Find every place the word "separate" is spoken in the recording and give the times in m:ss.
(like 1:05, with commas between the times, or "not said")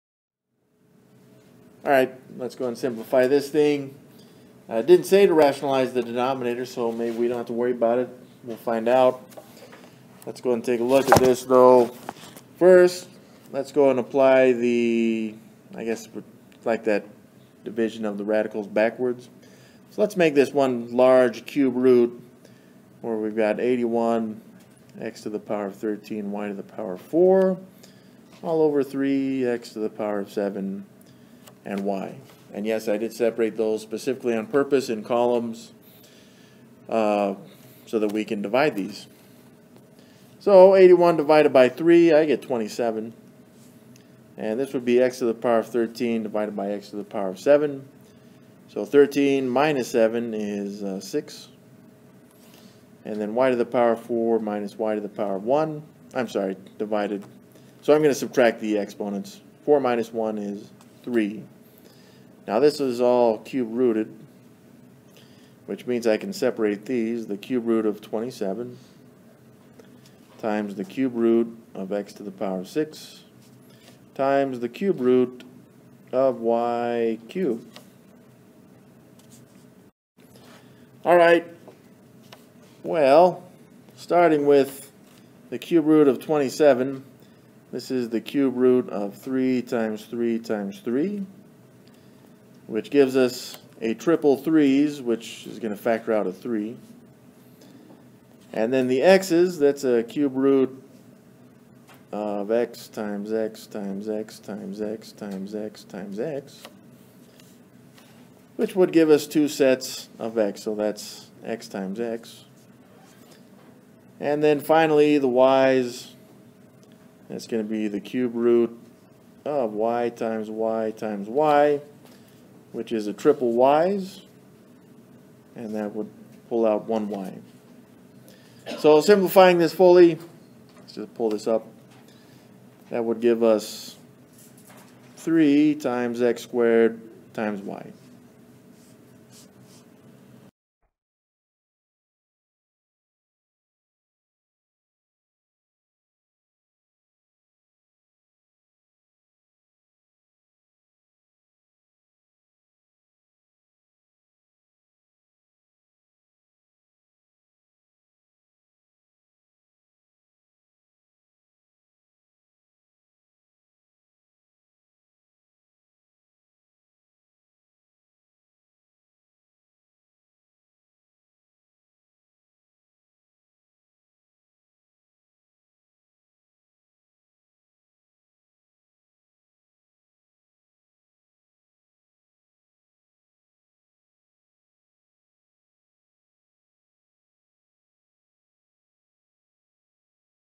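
0:33, 1:06.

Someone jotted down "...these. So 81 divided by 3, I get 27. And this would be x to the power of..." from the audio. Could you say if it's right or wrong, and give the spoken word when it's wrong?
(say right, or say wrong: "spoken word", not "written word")
right.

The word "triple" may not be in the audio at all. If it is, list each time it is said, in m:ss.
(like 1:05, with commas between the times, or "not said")
1:33, 2:03.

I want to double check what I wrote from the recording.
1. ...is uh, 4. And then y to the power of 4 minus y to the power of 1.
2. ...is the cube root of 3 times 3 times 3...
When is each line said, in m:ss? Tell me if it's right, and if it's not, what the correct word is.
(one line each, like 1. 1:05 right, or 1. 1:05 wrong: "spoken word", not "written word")
1. 0:50 wrong: "6", not "4"
2. 1:27 right.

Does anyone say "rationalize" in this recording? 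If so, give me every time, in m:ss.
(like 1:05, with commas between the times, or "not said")
0:05.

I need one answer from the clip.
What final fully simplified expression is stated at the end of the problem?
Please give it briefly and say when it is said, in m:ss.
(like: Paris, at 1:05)
3x²y, at 2:15.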